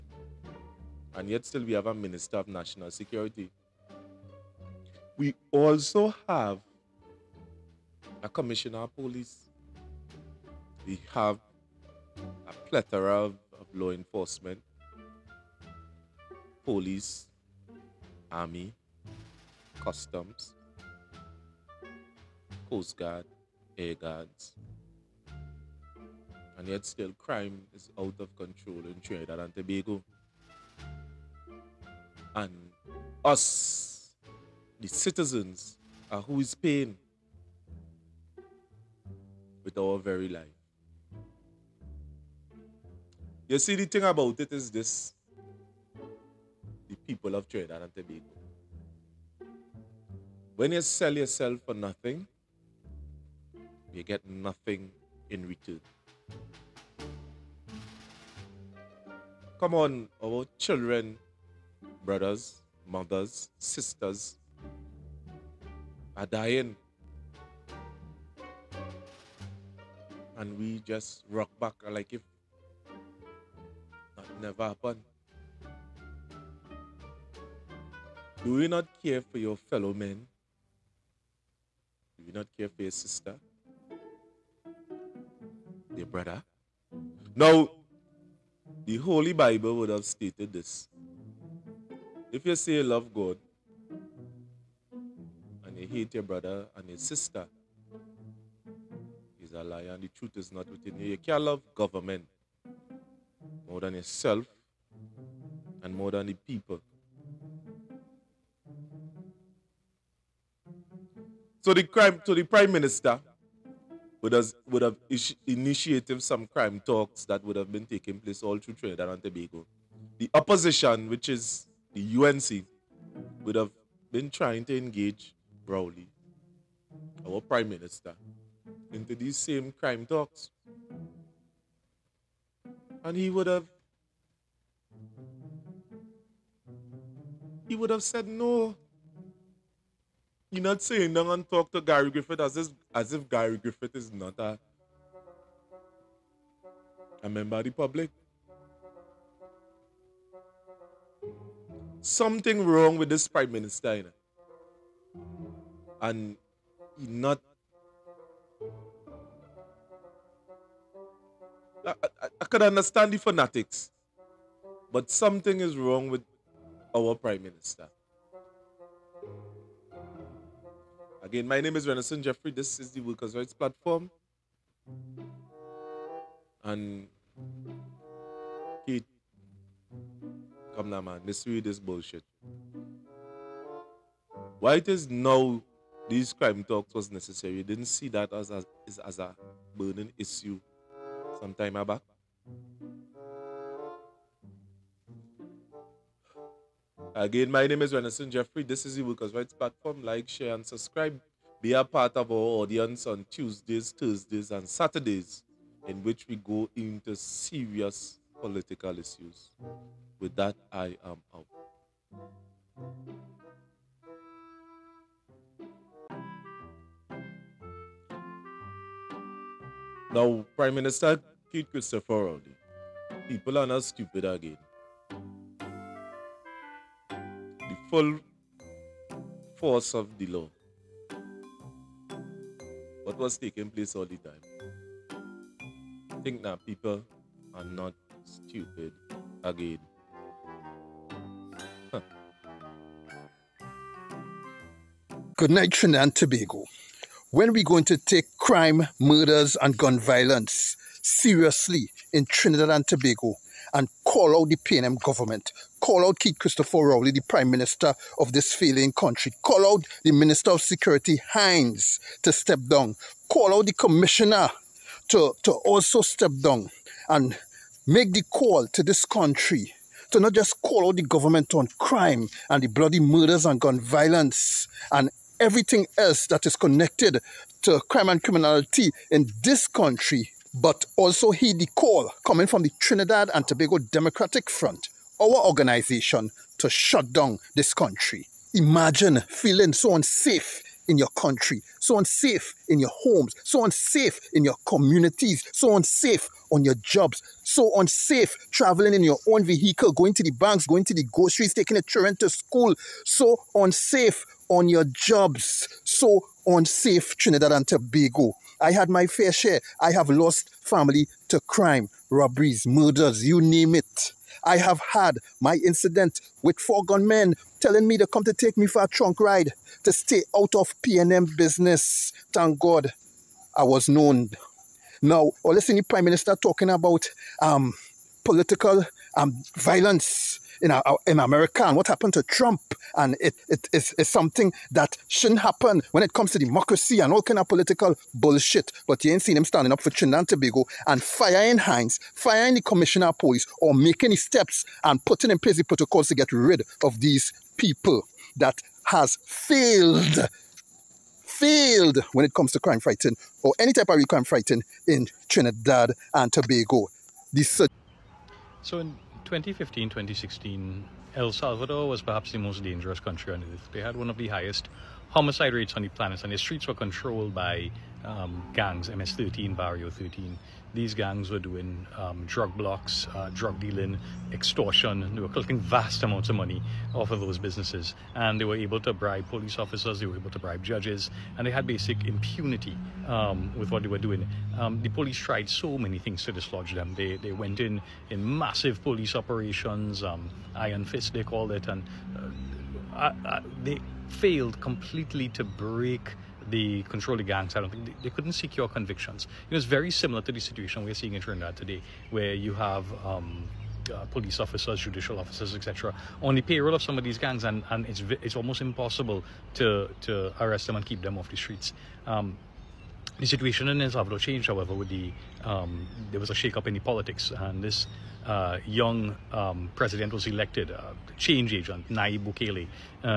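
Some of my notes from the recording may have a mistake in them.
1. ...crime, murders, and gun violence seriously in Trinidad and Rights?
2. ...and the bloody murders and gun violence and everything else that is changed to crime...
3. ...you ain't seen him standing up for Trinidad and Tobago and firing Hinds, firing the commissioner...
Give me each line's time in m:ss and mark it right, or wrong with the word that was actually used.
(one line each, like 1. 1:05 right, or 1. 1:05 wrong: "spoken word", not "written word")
1. 4:08 wrong: "Tobago", not "Rights"
2. 4:32 wrong: "connected", not "changed"
3. 5:39 right.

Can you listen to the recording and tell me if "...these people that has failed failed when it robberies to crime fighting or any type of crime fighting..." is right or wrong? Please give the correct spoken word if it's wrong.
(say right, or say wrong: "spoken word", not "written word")
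wrong: "comes", not "robberies".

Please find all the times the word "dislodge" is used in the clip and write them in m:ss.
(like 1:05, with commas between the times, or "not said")
6:26.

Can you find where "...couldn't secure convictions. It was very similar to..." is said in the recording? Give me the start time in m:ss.
6:38.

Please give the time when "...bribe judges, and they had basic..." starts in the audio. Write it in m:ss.
6:20.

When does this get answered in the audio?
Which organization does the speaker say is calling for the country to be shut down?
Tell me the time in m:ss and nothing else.
4:42.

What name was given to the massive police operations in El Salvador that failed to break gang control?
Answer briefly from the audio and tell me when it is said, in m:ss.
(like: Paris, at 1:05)
Iron fist, at 6:30.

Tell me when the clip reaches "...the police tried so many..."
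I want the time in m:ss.
6:24.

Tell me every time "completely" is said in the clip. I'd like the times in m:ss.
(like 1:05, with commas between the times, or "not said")
6:34.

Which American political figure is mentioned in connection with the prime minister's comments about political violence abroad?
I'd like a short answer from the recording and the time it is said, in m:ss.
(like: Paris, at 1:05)
Trump, at 5:32.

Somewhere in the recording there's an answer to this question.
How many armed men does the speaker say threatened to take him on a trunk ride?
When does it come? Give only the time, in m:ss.
5:16.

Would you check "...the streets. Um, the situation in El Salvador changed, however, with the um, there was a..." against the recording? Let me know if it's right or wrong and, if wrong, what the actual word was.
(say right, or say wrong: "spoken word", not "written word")
right.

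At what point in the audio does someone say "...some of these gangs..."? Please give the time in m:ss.
6:46.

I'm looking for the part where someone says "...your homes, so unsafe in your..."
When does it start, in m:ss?
4:52.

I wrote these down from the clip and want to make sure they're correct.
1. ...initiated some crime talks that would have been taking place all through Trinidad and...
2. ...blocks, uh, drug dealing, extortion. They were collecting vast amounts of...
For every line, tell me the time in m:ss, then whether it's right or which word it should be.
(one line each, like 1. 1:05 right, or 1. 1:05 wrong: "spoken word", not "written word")
1. 1:55 right
2. 6:12 right.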